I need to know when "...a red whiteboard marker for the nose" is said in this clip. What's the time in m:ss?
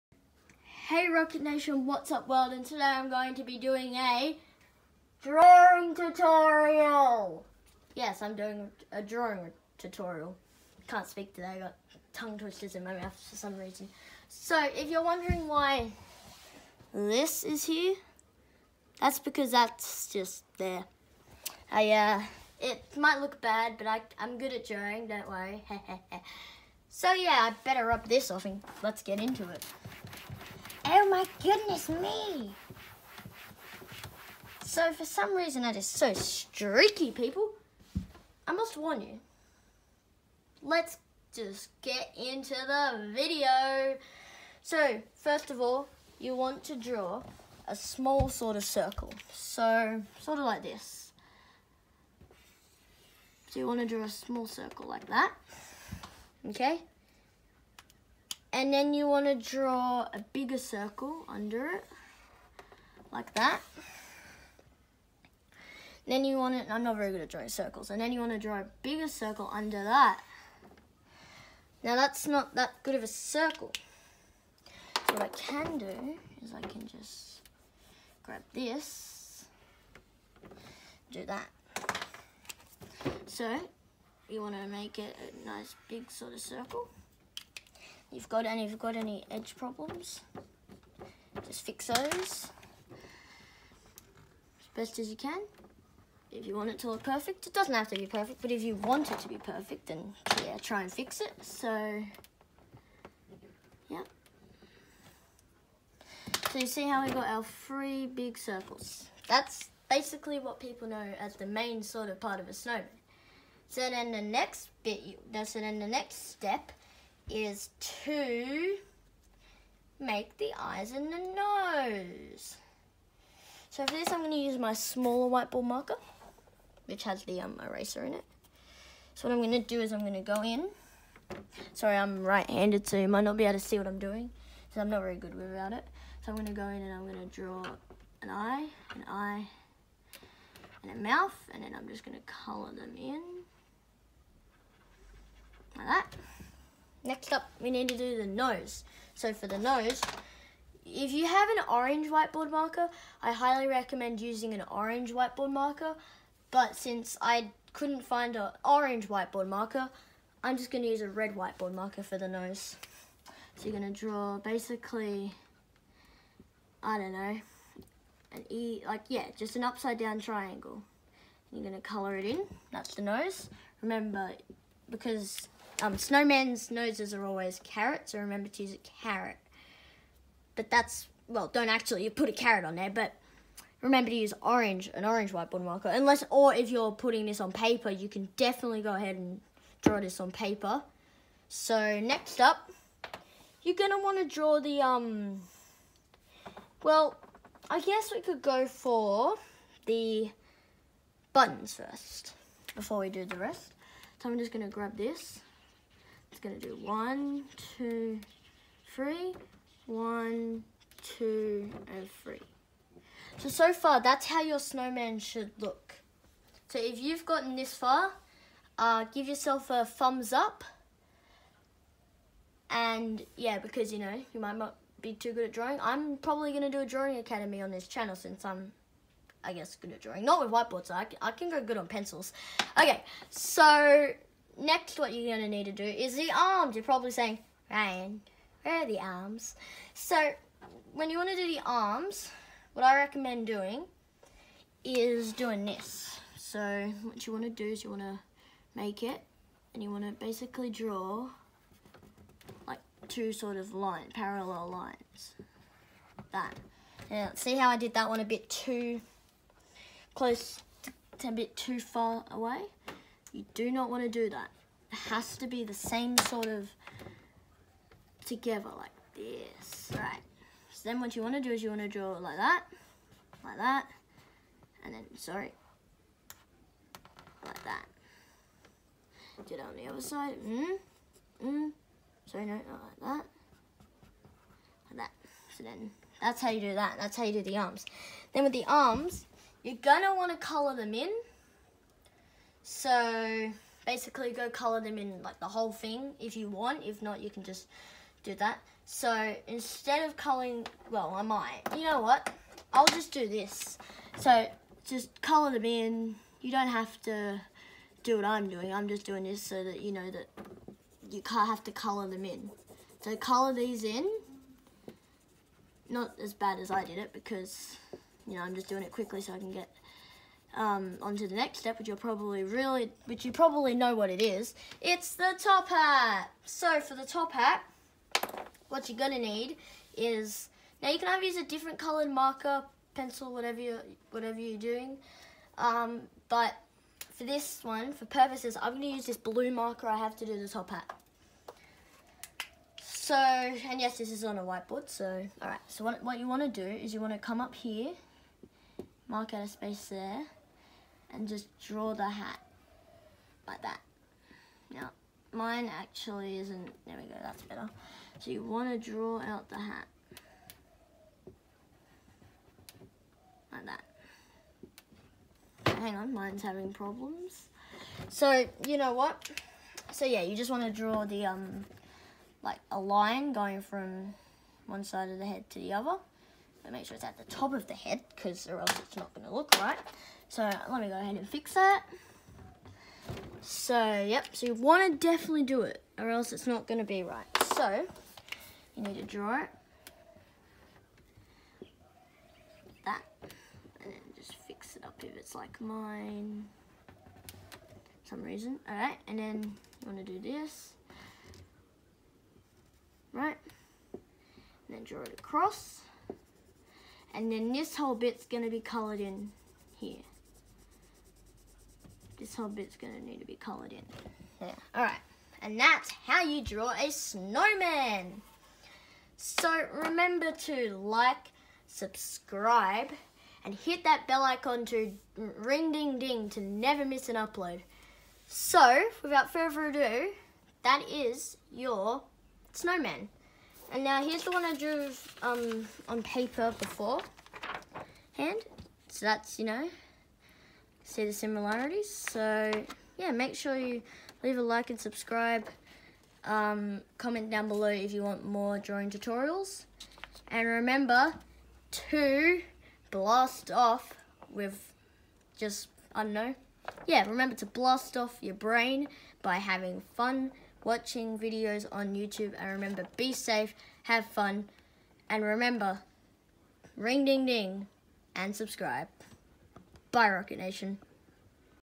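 2:41.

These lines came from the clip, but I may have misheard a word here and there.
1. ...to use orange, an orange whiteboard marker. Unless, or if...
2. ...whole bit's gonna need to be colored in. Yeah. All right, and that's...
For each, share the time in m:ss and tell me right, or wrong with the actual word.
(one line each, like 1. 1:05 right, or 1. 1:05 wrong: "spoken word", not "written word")
1. 3:04 right
2. 6:52 right.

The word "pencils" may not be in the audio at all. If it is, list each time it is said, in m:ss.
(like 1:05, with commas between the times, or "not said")
3:51, 5:32.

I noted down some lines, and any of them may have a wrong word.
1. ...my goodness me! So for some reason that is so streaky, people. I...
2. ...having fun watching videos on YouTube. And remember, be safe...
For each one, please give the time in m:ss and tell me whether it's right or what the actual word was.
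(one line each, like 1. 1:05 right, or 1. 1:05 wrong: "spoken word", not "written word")
1. 0:31 right
2. 7:39 right.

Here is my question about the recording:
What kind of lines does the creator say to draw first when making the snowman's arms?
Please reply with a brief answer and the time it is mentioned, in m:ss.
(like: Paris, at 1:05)
Parallel lines, at 4:14.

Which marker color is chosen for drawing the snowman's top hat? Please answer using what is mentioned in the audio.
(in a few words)
Blue.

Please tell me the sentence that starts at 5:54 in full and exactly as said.
Now, mine actually isn't, there we go, that's better.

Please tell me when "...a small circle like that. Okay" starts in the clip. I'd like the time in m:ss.
0:54.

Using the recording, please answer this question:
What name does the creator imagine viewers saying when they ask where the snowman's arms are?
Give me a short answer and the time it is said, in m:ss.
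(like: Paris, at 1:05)
Ryan, at 3:57.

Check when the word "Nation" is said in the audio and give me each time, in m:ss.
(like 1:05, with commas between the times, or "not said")
0:01, 7:50.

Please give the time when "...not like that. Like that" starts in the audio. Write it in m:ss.
4:42.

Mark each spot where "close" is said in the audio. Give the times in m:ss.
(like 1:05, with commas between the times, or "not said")
4:20.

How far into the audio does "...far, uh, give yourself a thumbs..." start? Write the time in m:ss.
3:37.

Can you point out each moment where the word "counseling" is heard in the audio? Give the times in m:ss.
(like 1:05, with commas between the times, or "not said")
not said.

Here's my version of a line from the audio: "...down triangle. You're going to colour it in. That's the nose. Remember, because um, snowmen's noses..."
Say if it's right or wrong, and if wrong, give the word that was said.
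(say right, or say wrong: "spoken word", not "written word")
right.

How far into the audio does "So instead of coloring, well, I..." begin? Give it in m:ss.
4:58.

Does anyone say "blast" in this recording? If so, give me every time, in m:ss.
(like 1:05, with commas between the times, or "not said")
7:32, 7:37.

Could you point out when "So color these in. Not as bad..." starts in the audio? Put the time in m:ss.
5:13.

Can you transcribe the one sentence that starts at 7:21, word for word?
So yeah, make sure you leave a like and subscribe.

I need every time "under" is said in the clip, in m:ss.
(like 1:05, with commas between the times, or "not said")
1:01, 1:09.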